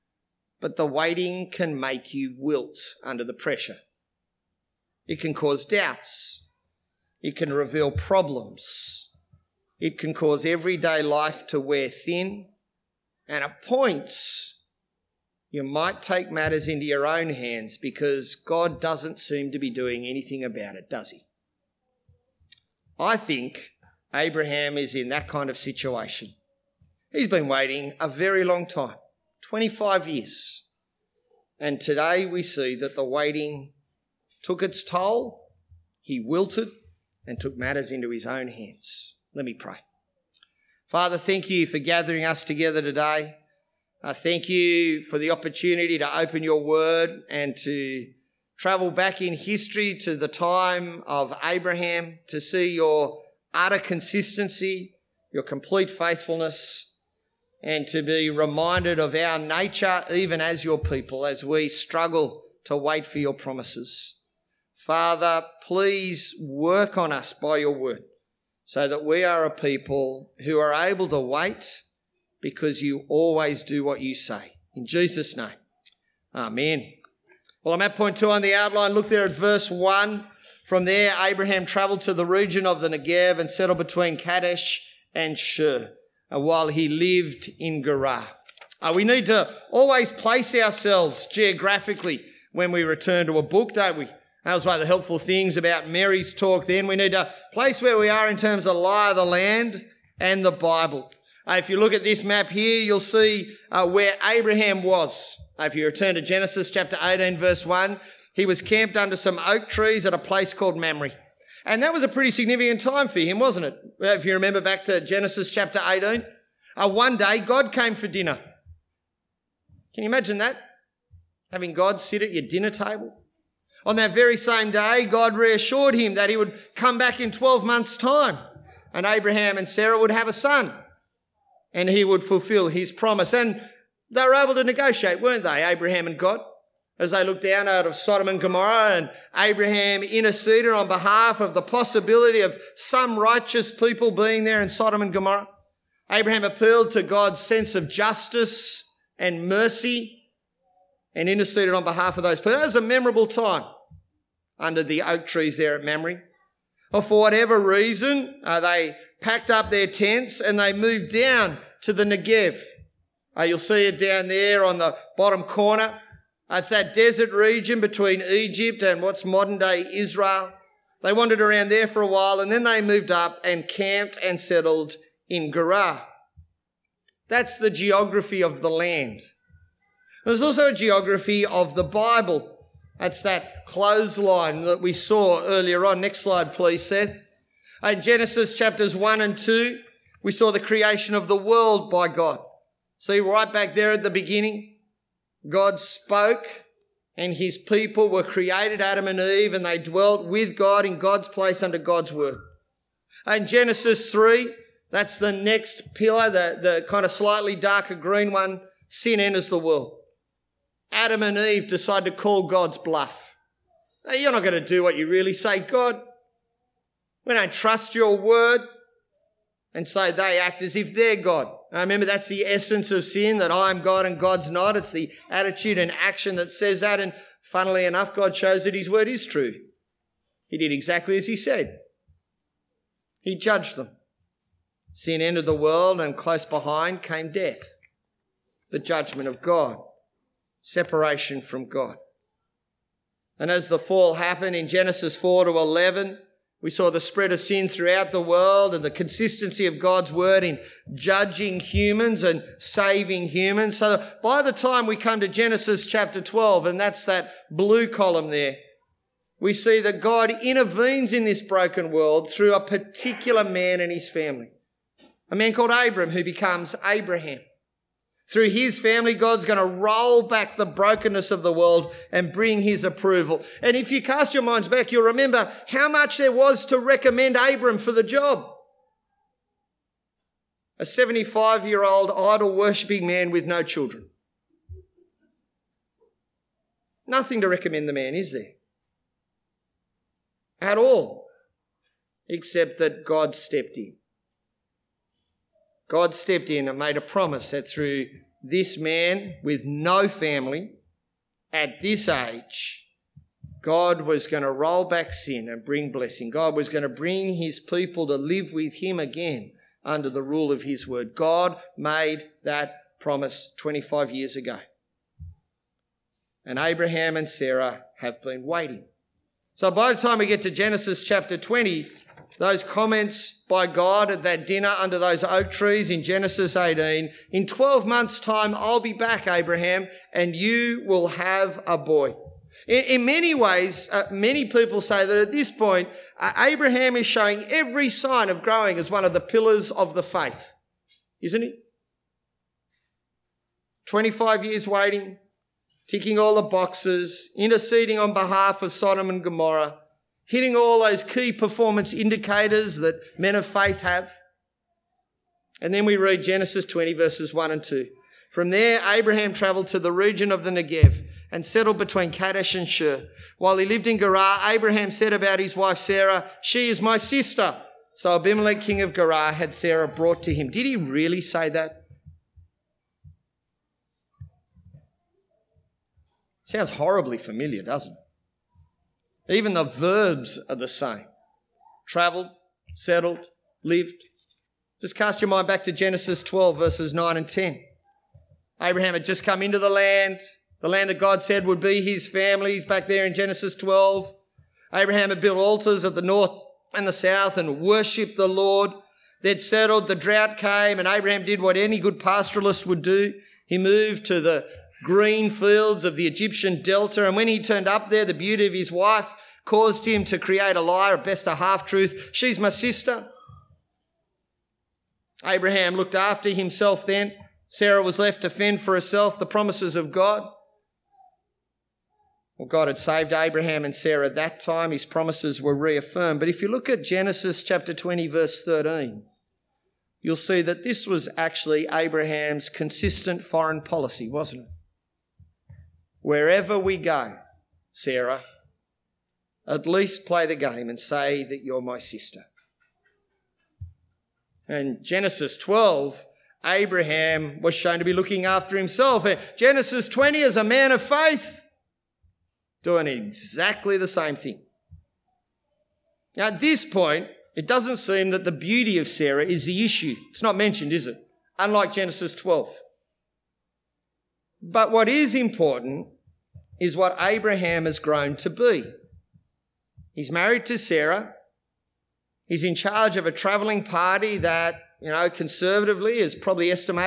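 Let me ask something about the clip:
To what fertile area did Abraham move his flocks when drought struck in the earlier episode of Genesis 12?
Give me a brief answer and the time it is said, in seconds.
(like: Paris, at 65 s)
Egyptian delta, at 406 s.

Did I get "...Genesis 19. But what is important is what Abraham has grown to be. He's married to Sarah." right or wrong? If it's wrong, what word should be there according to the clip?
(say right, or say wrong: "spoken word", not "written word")
wrong: "12", not "19".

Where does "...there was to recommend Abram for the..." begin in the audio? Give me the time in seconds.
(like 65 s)
276 s.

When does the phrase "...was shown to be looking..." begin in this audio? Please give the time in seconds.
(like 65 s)
447 s.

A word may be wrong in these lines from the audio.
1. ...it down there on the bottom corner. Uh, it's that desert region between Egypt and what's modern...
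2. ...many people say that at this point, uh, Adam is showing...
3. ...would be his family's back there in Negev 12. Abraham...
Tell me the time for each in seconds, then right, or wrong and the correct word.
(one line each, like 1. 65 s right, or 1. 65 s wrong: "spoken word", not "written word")
1. 163 s right
2. 334 s wrong: "Abraham", not "Adam"
3. 391 s wrong: "Genesis", not "Negev".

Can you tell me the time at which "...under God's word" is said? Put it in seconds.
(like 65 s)
201 s.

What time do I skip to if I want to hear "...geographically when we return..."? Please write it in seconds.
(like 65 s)
91 s.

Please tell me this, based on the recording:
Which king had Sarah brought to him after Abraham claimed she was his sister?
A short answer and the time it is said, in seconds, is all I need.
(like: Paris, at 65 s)
Abimelech, at 368 s.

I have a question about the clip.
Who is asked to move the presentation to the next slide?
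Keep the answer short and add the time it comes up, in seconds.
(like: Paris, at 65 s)
Seth, at 186 s.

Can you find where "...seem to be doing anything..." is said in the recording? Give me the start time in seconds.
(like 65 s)
19 s.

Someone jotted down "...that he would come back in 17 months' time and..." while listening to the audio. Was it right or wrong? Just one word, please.
wrong.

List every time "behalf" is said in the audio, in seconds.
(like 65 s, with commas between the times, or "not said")
140 s, 151 s, 348 s.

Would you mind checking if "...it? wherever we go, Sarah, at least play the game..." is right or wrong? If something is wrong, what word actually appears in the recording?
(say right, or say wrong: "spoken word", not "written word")
right.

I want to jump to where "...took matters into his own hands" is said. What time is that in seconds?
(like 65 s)
37 s.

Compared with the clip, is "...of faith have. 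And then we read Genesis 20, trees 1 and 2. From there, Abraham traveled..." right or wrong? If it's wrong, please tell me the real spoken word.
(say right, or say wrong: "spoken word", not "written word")
wrong: "verses", not "trees".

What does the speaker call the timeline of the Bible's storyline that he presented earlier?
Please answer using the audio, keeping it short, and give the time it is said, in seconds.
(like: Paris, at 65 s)
clothesline, at 183 s.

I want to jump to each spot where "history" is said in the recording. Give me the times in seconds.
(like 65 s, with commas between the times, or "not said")
49 s.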